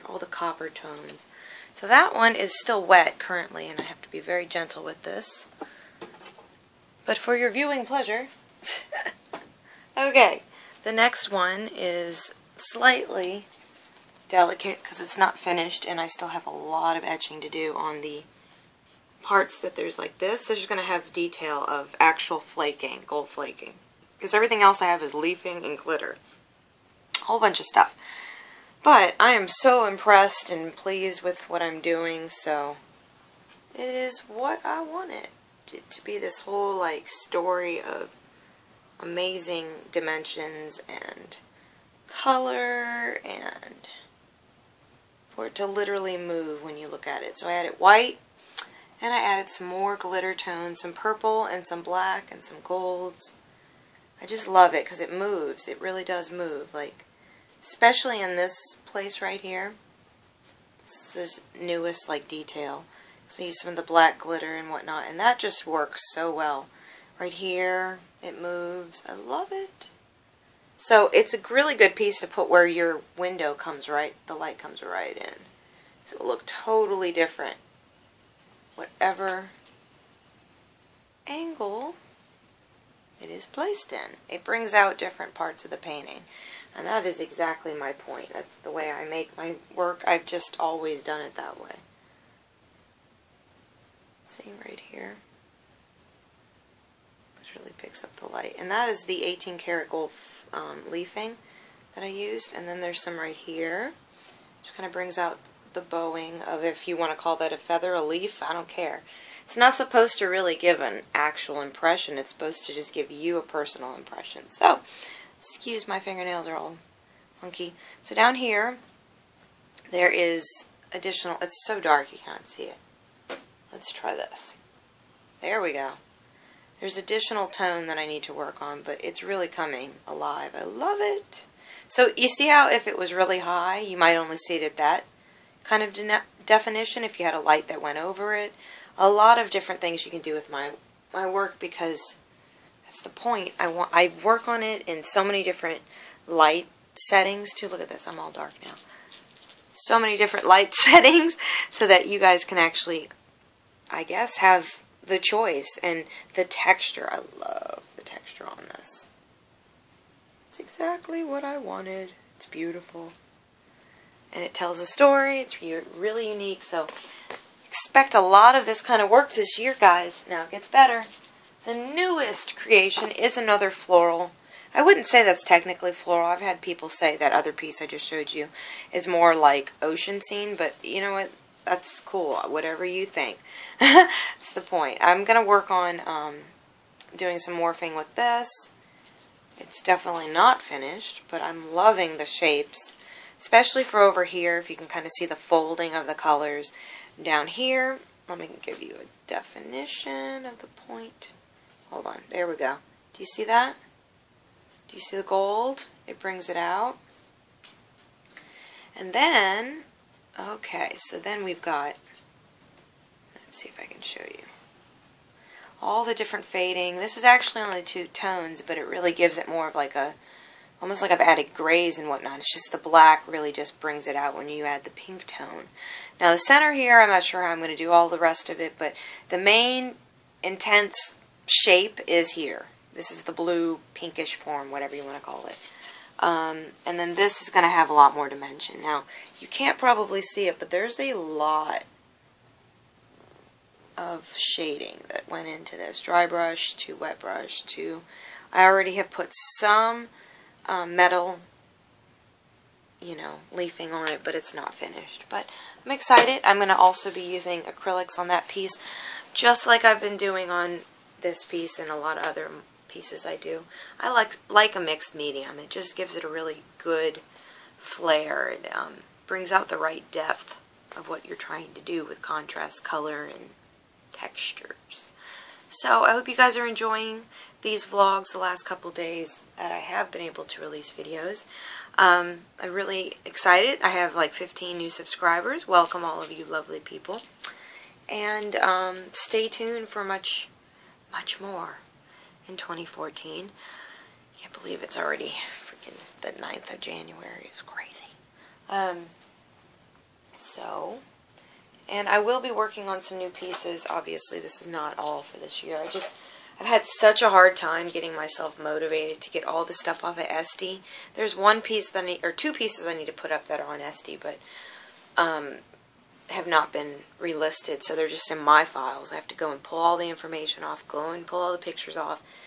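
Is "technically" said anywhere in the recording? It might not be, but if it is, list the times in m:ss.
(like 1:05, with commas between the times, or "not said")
2:55.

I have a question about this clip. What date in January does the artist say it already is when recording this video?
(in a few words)
9th of January.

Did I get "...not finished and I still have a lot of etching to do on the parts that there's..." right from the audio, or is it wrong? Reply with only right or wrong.
right.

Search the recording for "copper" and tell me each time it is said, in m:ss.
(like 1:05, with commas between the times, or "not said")
0:00.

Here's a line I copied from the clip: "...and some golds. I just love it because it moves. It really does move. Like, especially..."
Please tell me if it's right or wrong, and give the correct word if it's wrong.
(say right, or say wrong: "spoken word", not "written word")
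right.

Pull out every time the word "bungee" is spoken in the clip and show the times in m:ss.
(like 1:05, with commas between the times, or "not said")
not said.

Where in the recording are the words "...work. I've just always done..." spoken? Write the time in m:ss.
1:29.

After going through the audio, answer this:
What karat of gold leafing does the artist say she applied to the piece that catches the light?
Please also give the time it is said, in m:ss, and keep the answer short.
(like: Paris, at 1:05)
18 karat, at 1:39.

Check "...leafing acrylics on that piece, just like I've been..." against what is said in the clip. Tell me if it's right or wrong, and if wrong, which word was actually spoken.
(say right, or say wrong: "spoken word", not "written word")
wrong: "using", not "leafing".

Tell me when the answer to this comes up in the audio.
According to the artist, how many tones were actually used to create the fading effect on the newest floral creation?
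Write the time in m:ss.
3:37.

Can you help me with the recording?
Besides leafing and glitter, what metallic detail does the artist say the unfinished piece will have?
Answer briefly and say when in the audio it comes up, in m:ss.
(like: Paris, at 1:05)
Gold flaking, at 0:23.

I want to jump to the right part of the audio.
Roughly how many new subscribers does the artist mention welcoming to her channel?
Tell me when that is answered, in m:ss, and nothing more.
4:44.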